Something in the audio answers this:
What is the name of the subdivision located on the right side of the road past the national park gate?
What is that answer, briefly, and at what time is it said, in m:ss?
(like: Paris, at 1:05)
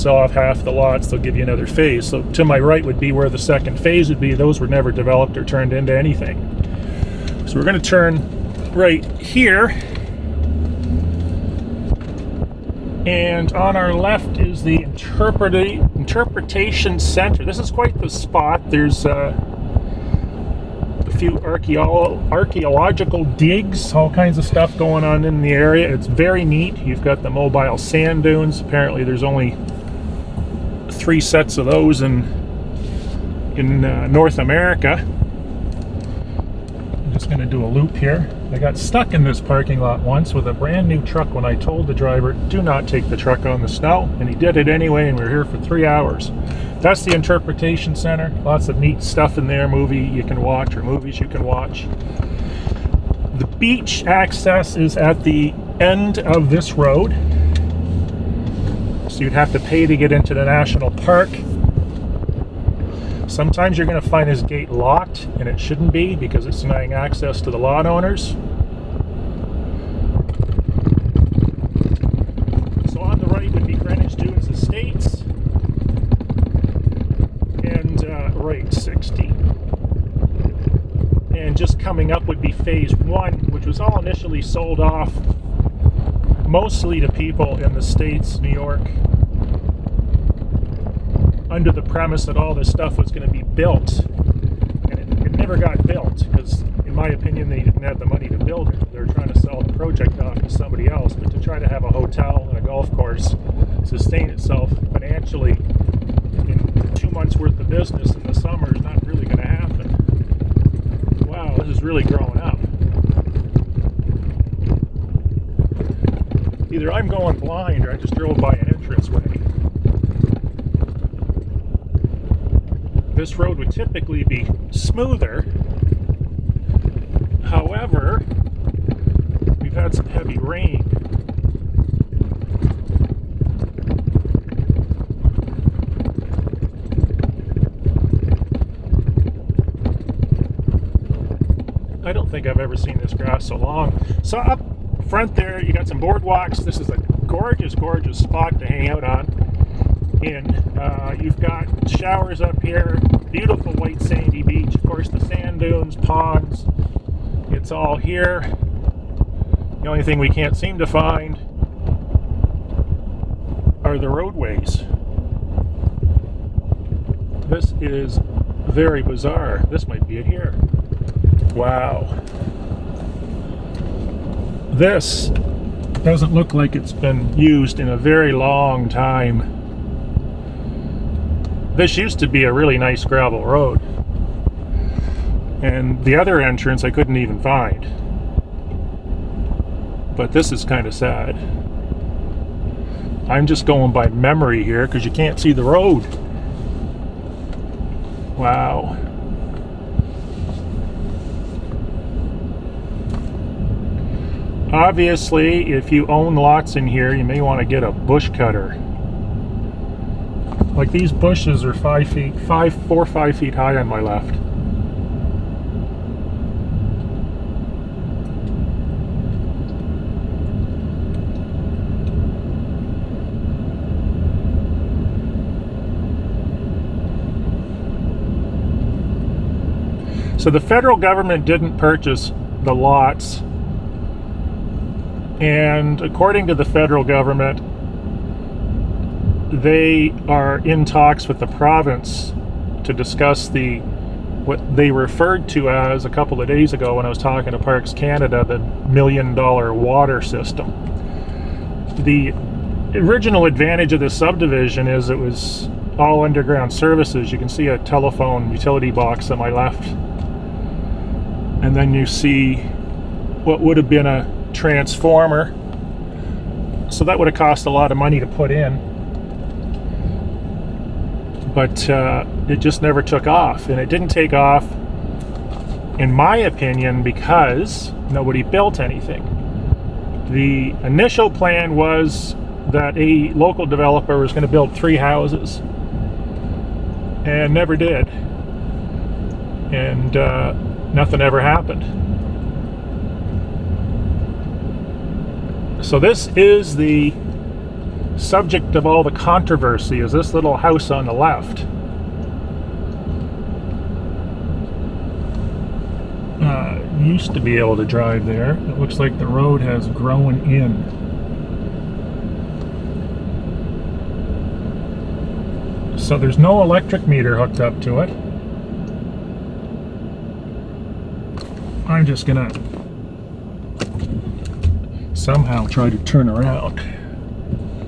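Greenwich Dunes Estates, at 1:13.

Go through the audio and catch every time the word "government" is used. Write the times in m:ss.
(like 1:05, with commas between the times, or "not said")
3:50, 3:57.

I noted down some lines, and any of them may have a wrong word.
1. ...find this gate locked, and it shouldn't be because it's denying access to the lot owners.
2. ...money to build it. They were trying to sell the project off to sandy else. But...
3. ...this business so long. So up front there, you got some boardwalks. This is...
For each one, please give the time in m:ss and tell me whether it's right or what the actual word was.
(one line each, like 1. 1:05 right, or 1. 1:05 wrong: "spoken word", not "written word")
1. 1:04 right
2. 1:38 wrong: "somebody", not "sandy"
3. 2:22 wrong: "grass", not "business".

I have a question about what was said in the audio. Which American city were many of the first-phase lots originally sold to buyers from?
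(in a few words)
New York.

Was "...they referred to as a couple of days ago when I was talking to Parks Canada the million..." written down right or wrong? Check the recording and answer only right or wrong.
right.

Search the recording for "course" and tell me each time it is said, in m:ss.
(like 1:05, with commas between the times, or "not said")
1:42, 2:34.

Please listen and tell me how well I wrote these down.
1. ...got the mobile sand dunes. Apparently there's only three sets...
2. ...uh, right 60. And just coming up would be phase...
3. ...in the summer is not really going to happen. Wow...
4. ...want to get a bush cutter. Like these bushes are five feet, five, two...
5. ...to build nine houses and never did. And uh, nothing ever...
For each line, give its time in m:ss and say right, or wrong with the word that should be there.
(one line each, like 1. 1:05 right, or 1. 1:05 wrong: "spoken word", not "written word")
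1. 0:27 right
2. 1:18 right
3. 1:48 right
4. 3:27 wrong: "four", not "two"
5. 4:44 wrong: "three", not "nine".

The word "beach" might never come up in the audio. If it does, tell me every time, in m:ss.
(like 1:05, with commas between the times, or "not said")
0:53, 2:34.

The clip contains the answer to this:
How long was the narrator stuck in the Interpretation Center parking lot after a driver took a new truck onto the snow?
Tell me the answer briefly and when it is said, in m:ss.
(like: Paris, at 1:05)
3 hours, at 0:45.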